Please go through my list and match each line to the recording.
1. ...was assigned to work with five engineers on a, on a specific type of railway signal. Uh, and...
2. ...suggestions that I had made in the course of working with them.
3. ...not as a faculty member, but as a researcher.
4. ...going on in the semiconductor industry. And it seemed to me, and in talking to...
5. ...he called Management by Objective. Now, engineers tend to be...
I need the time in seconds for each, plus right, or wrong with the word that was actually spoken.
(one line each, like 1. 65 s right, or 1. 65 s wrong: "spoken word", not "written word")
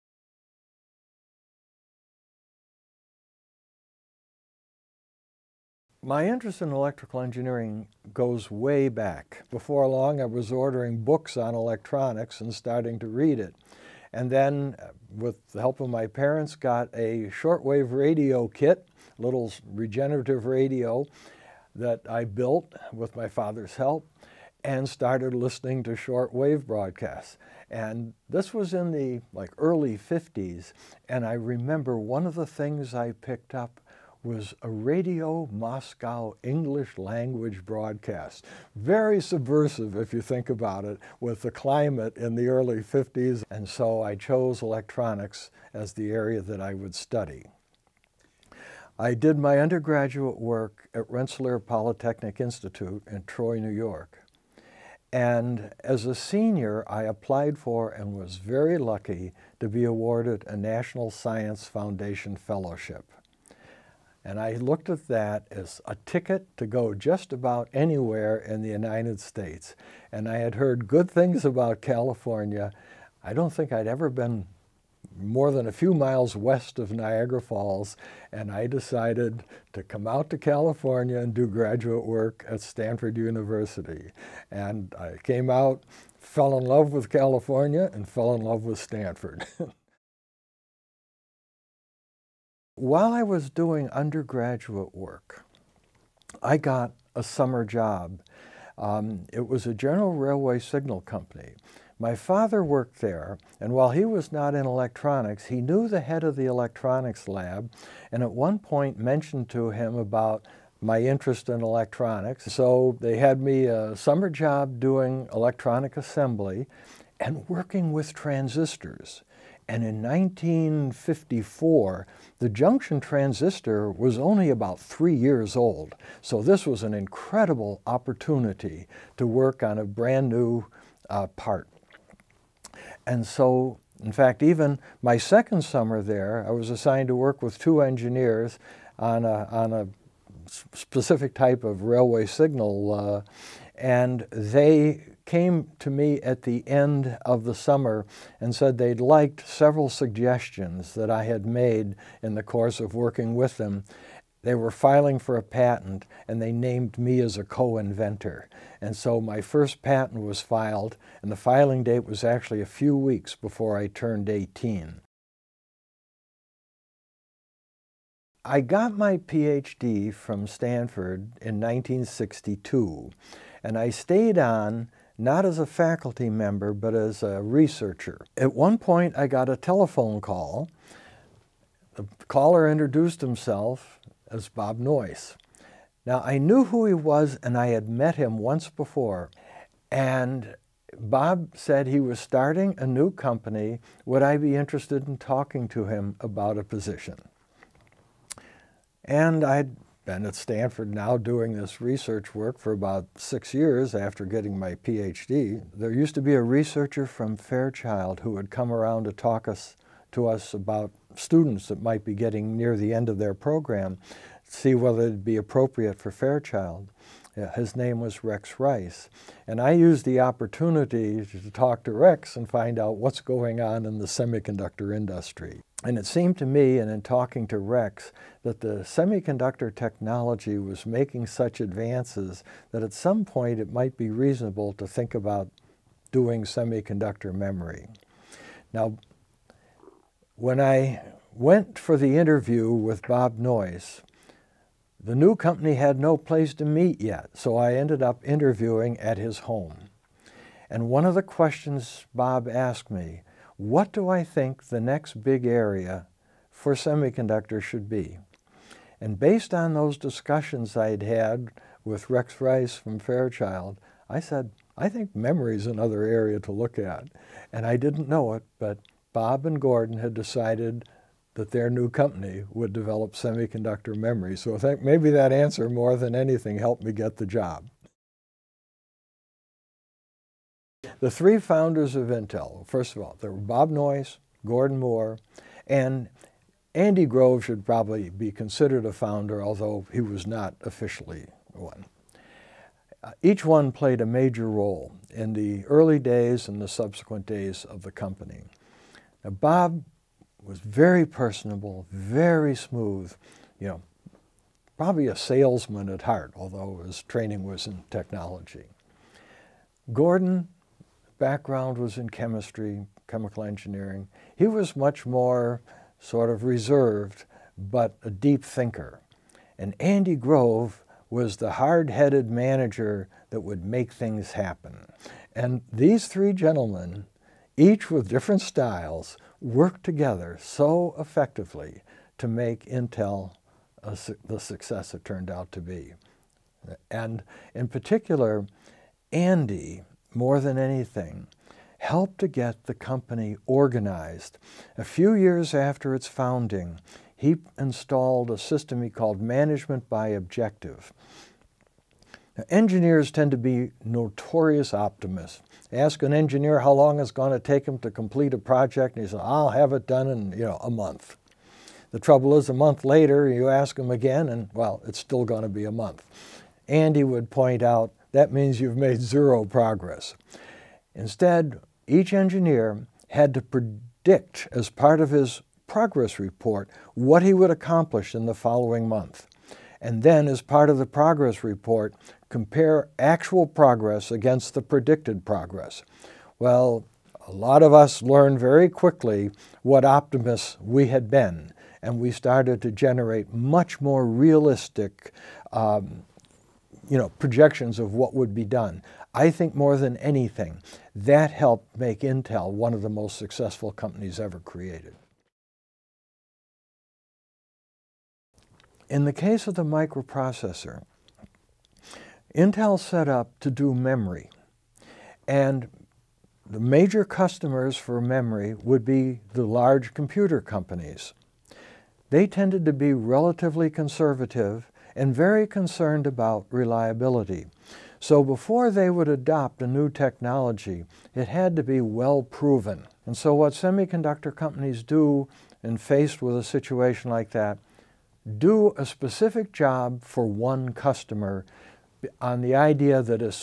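1. 136 s wrong: "two", not "five"
2. 149 s right
3. 175 s right
4. 223 s right
5. 348 s right.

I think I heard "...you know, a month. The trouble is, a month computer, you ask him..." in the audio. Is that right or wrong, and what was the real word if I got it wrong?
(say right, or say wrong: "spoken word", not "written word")
wrong: "later", not "computer".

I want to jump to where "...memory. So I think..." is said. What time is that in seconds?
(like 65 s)
273 s.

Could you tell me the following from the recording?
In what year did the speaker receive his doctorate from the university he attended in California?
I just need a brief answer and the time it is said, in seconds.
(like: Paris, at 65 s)
1962, at 171 s.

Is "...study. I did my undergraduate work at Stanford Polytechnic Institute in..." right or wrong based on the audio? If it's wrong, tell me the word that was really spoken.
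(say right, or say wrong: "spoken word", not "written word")
wrong: "Rensselaer", not "Stanford".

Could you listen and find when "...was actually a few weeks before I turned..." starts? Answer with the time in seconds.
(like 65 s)
162 s.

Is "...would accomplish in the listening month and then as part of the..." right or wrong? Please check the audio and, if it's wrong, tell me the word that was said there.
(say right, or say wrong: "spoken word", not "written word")
wrong: "following", not "listening".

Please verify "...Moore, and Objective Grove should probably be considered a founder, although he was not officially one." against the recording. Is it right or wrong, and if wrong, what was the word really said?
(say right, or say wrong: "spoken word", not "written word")
wrong: "Andy", not "Objective".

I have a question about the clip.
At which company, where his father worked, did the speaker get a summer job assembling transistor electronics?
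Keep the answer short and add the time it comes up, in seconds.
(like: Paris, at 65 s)
General Railway Signal Company, at 99 s.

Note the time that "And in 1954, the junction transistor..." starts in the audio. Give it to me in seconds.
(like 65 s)
119 s.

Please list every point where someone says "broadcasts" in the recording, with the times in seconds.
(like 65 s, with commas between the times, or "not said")
26 s, 37 s.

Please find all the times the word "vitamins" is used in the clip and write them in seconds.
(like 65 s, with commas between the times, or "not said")
not said.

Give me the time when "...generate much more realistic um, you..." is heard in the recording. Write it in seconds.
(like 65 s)
392 s.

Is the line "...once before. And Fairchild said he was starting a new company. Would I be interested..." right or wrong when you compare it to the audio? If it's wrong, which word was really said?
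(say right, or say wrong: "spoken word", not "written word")
wrong: "Bob", not "Fairchild".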